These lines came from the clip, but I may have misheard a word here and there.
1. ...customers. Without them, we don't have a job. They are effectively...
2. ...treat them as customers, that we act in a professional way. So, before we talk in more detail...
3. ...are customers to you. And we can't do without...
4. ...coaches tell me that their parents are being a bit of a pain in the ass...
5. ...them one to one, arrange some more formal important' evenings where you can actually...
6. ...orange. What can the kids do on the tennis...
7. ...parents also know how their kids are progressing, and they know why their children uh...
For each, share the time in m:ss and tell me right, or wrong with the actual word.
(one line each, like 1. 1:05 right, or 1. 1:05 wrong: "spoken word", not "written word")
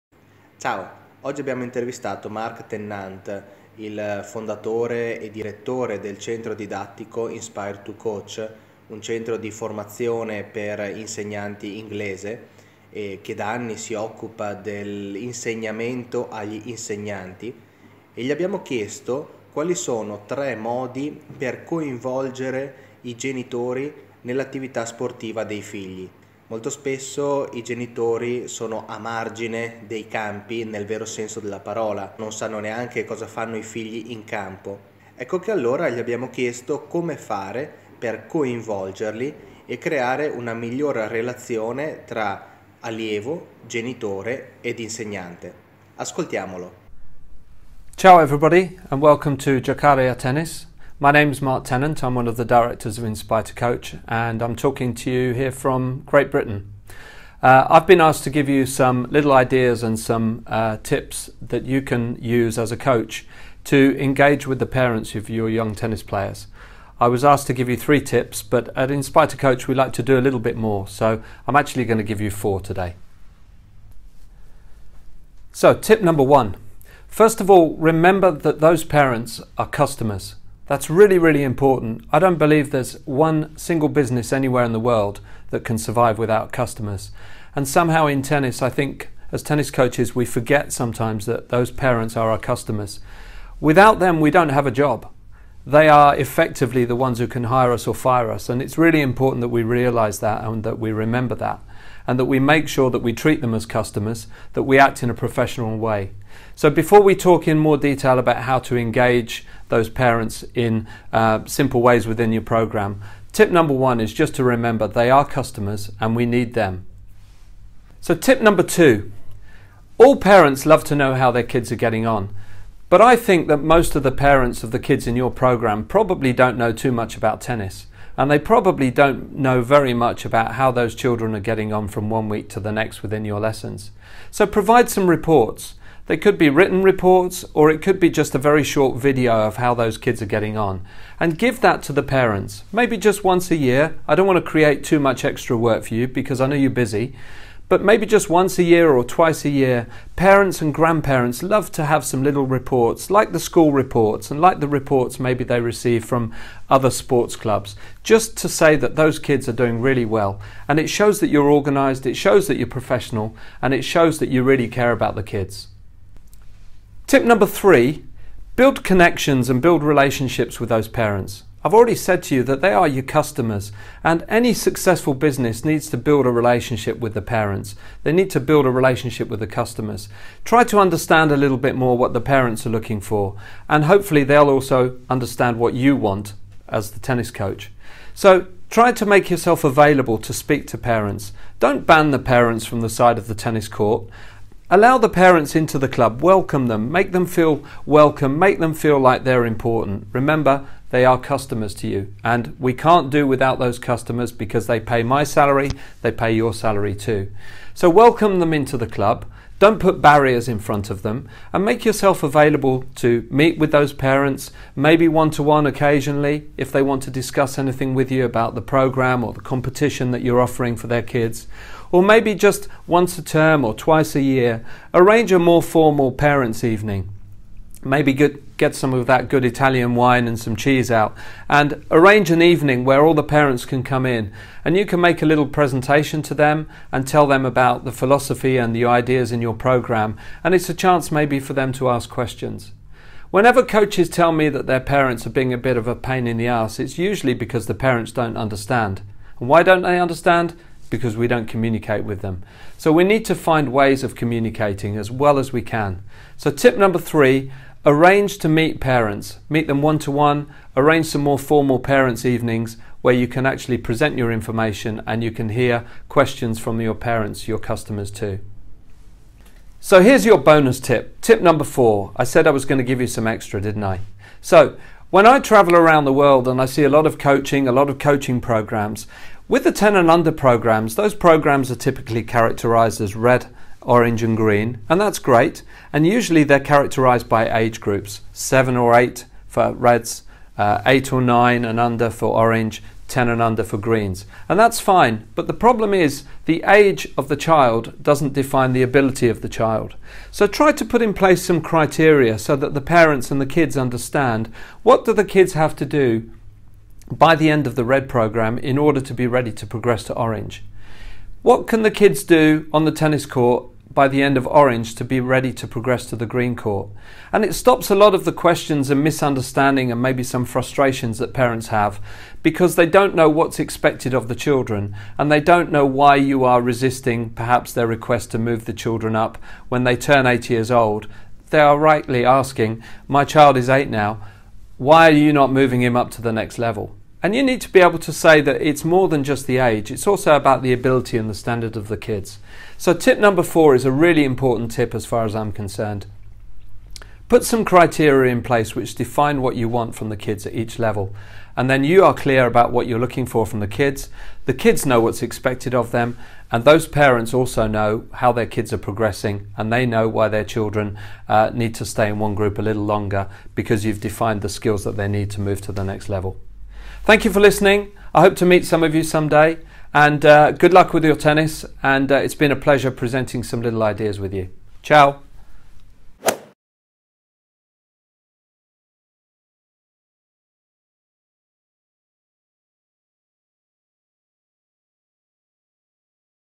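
1. 1:32 right
2. 1:43 right
3. 3:21 right
4. 4:03 right
5. 4:19 wrong: "parents", not "important"
6. 5:10 right
7. 5:56 right.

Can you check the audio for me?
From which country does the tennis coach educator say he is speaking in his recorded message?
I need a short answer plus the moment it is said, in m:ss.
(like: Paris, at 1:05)
Great Britain, at 0:56.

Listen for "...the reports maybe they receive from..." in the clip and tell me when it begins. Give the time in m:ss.
2:34.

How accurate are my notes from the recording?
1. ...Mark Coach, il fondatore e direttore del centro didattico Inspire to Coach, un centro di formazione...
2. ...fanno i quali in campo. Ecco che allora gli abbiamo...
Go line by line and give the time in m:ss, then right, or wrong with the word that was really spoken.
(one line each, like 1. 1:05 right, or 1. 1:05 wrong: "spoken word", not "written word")
1. 0:02 wrong: "Tennant", not "Coach"
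2. 0:33 wrong: "figli", not "quali".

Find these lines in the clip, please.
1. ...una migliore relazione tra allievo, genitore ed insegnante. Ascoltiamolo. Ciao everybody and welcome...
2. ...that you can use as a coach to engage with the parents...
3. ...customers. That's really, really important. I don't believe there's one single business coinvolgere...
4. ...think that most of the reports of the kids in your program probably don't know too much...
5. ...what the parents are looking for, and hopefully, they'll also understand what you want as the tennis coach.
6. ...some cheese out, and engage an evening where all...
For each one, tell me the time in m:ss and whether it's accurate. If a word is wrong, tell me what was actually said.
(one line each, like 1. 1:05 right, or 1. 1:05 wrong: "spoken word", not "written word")
1. 0:40 right
2. 1:01 right
3. 1:19 wrong: "anywhere", not "coinvolgere"
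4. 2:03 wrong: "parents", not "reports"
5. 3:01 right
6. 3:50 wrong: "arrange", not "engage".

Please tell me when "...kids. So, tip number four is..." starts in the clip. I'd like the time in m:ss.
5:41.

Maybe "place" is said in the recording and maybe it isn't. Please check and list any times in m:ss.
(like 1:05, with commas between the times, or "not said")
5:01, 5:48.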